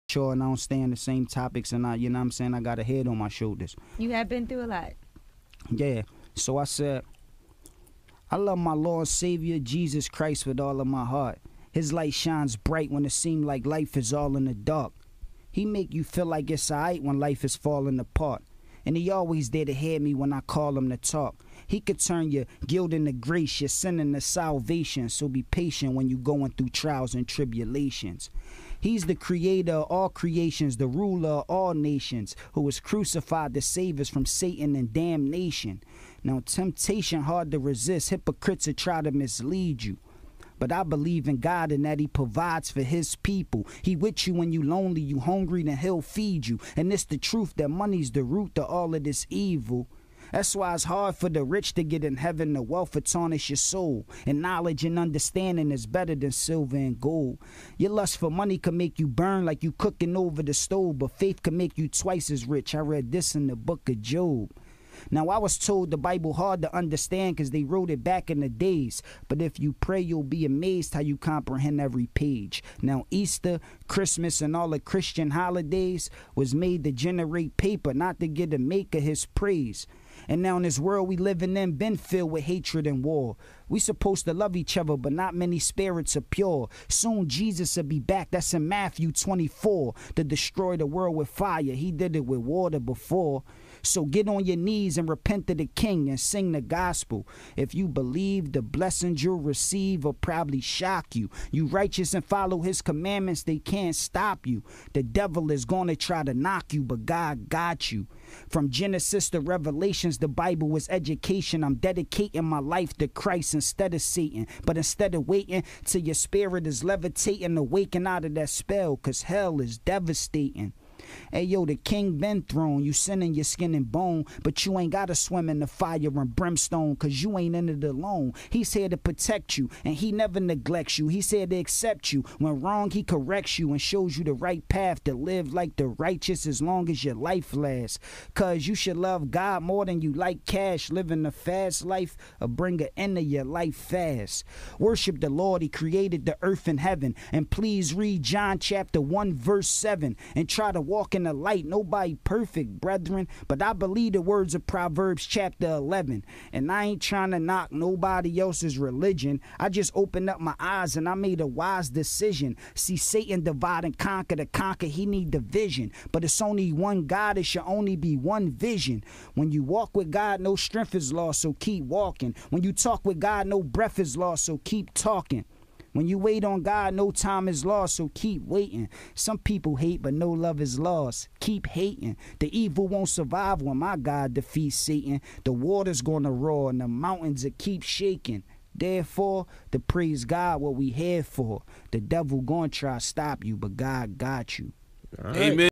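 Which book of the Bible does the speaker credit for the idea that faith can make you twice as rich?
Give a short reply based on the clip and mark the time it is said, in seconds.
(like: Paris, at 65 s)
Job, at 63 s.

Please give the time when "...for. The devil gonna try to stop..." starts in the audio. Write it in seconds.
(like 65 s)
191 s.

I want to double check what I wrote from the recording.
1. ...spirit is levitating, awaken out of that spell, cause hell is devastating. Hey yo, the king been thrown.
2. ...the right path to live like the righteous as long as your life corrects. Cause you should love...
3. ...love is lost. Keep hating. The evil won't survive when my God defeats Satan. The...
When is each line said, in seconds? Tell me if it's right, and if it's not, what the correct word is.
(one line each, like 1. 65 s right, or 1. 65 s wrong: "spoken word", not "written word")
1. 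116 s right
2. 134 s wrong: "lasts", not "corrects"
3. 180 s right.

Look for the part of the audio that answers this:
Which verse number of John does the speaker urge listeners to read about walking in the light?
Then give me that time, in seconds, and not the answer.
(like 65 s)
149 s.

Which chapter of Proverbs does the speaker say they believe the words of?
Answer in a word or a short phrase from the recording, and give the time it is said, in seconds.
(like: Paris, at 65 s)
11, at 154 s.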